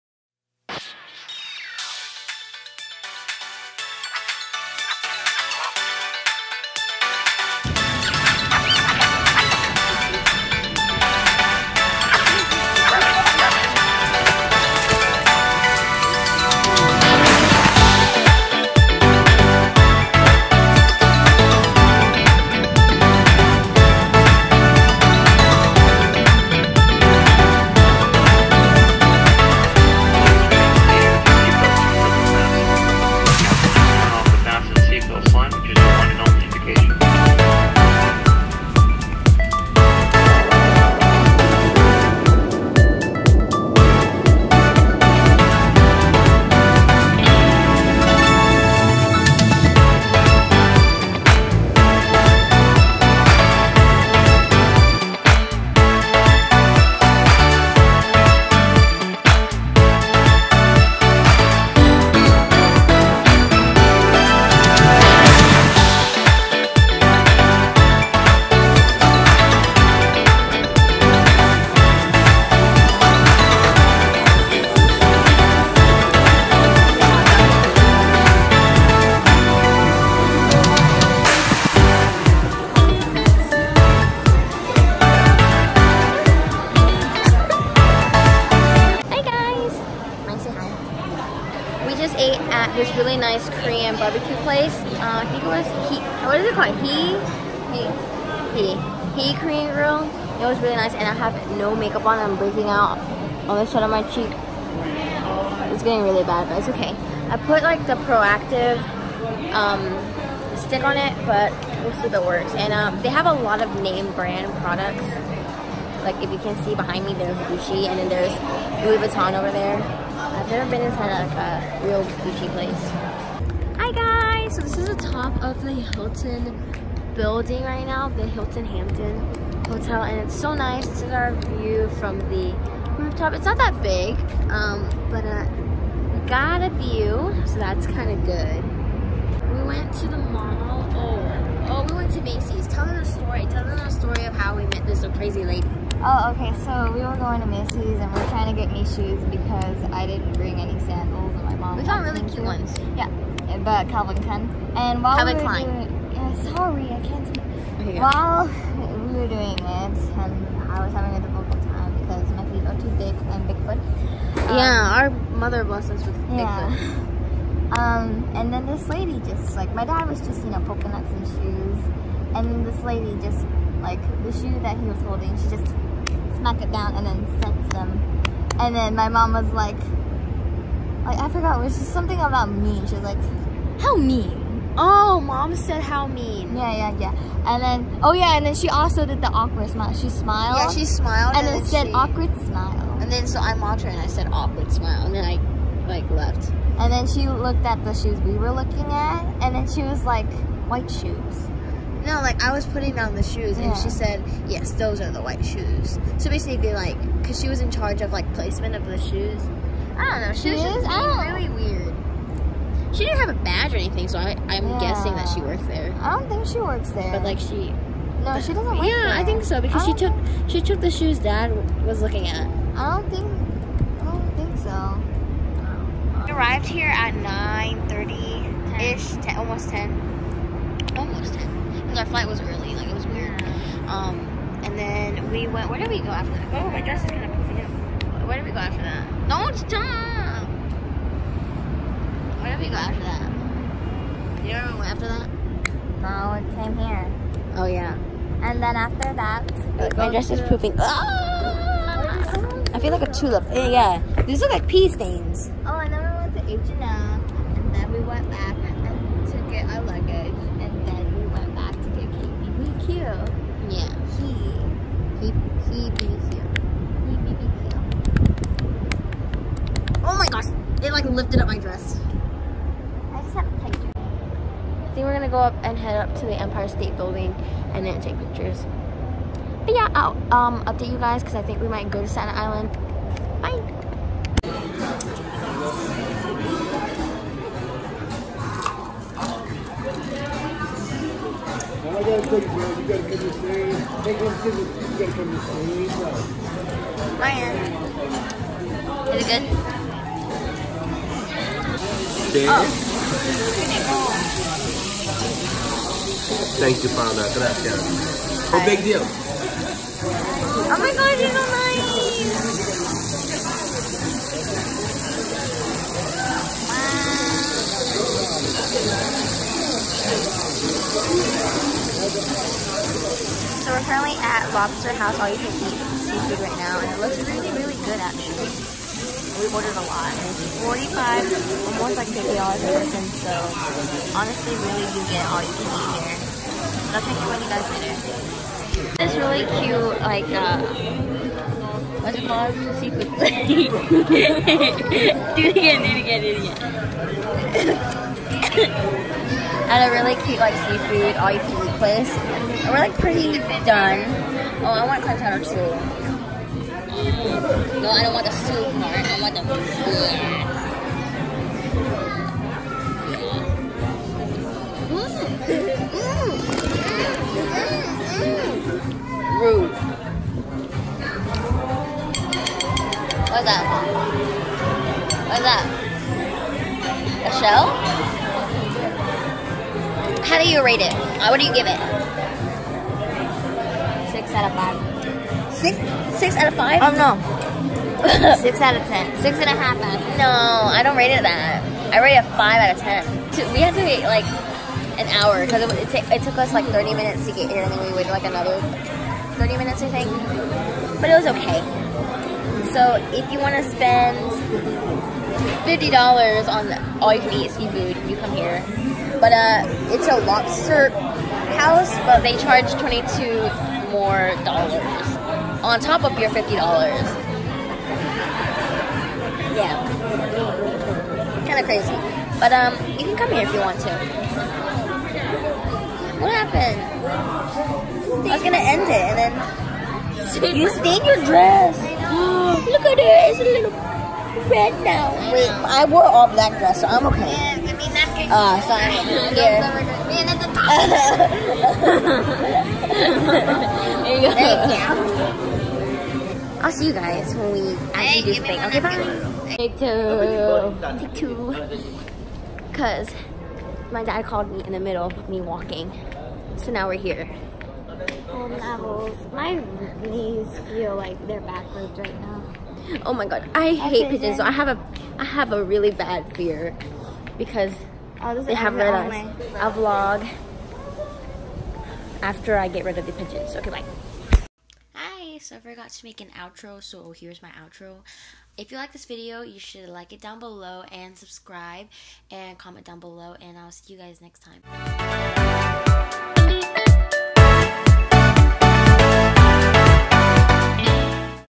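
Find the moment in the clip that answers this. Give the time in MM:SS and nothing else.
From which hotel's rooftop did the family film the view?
02:08.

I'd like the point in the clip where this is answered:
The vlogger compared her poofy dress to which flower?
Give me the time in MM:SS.
04:13.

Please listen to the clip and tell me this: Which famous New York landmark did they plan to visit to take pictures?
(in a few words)
Empire State Building.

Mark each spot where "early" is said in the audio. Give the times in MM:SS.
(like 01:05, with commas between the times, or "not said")
03:52.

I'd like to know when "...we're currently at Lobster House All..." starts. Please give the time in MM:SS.
05:23.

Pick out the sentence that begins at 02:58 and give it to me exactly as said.
And then my mom was like, like, I forgot, it was just something about mean.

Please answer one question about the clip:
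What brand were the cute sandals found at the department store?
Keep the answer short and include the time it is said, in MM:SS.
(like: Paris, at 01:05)
Calvin Klein, at 02:33.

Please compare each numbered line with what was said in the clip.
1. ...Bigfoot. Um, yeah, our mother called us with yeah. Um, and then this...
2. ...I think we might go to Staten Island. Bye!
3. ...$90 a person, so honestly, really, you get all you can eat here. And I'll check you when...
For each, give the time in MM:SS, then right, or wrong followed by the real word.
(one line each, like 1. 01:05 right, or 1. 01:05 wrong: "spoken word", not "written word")
1. 02:43 wrong: "blessed", not "called"
2. 04:41 right
3. 05:32 wrong: "50", not "90".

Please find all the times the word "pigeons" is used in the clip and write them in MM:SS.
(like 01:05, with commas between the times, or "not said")
07:44, 07:53.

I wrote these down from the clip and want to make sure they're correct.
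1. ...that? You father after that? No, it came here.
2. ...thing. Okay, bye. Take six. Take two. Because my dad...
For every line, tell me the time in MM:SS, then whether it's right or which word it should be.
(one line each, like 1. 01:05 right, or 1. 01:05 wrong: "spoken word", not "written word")
1. 04:03 wrong: "remember", not "father"
2. 07:28 wrong: "two", not "six".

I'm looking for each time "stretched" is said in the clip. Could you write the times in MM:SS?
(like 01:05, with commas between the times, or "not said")
not said.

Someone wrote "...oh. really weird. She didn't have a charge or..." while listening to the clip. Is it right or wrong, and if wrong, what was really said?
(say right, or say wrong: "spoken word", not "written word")
wrong: "badge", not "charge".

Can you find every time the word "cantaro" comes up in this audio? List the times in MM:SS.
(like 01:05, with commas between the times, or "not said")
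05:55.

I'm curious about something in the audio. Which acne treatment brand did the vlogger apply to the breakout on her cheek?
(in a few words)
Proactiv.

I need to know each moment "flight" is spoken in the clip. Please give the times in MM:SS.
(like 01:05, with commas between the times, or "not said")
03:52.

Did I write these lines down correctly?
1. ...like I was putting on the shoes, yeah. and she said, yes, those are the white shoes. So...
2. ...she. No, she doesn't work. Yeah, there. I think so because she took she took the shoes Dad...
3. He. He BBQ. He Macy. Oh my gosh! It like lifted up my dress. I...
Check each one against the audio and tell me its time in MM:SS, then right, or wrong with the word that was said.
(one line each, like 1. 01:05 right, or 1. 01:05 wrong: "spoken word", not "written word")
1. 03:22 right
2. 03:37 right
3. 04:25 wrong: "BBQ", not "Macy".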